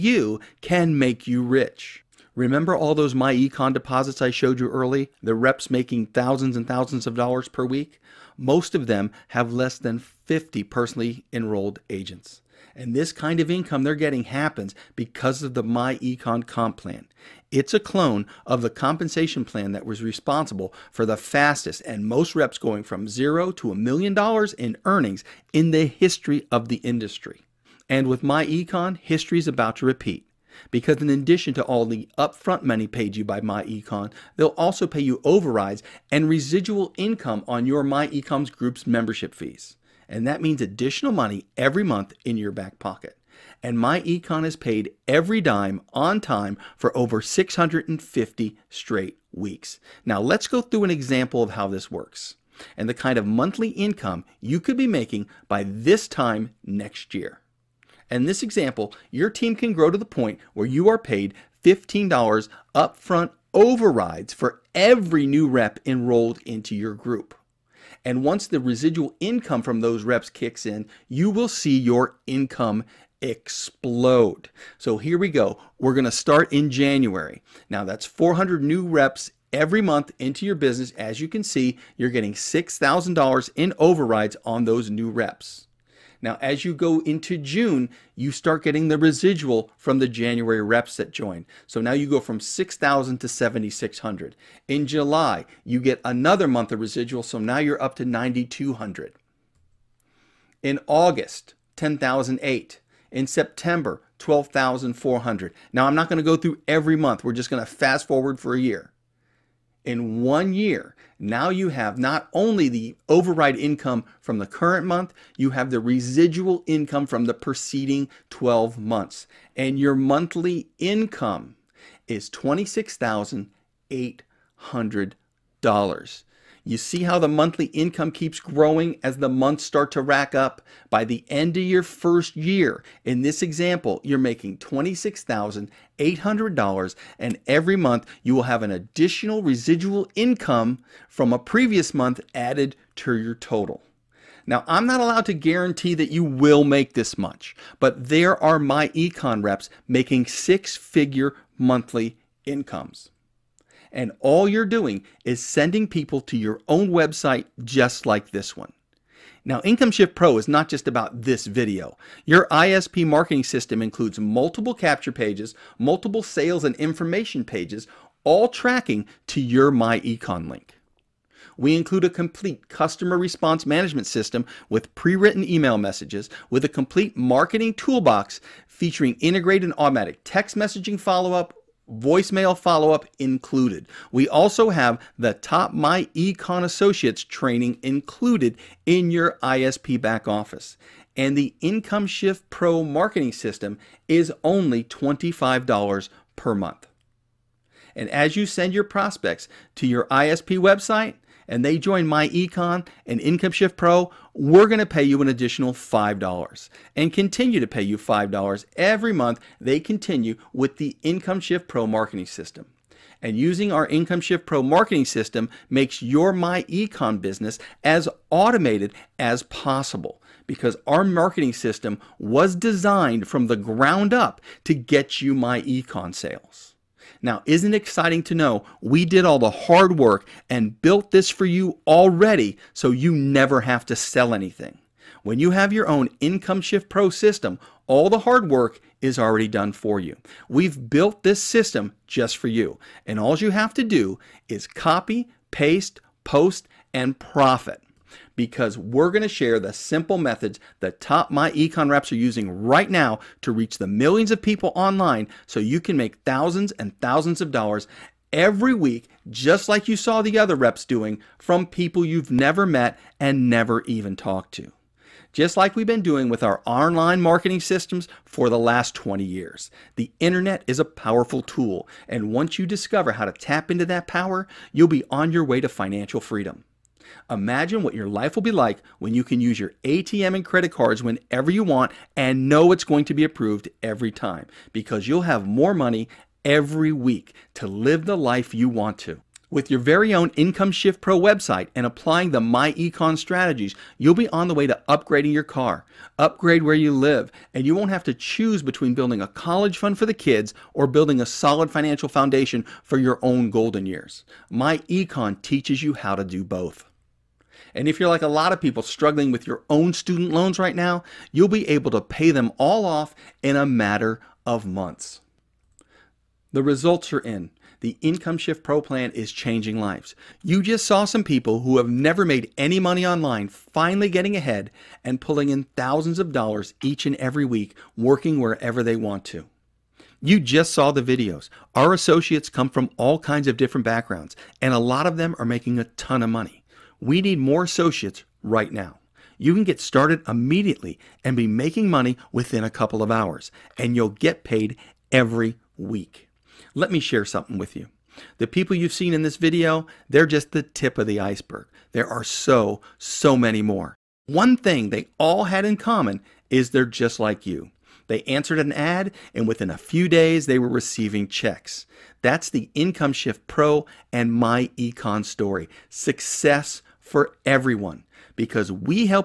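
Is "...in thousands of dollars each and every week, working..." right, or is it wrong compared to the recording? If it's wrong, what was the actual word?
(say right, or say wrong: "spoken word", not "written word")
right.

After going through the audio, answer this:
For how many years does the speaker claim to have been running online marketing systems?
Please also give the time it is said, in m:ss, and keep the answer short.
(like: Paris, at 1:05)
20 years, at 4:28.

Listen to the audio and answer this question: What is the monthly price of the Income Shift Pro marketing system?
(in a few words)
$25.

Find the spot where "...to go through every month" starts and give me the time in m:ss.
1:46.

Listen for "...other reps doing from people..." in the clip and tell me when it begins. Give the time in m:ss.
4:20.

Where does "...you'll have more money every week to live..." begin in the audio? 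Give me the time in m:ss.
4:45.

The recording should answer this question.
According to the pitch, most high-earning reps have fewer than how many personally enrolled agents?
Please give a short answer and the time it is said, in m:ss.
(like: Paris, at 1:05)
50, at 0:09.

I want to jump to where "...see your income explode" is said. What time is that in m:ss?
1:11.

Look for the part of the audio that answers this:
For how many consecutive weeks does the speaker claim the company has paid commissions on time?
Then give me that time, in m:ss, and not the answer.
0:47.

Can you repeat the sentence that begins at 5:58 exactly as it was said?
They answered an ad, and within a few days, they were receiving checks.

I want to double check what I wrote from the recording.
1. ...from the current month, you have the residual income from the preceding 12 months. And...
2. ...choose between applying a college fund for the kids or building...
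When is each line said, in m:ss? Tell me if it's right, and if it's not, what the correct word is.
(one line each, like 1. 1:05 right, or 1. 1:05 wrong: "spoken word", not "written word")
1. 1:54 right
2. 4:58 wrong: "building", not "applying".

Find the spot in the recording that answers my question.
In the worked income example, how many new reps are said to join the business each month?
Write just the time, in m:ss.
1:18.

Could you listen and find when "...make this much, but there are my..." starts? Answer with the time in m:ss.
2:26.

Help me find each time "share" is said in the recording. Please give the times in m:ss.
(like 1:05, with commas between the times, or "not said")
4:09, 5:47.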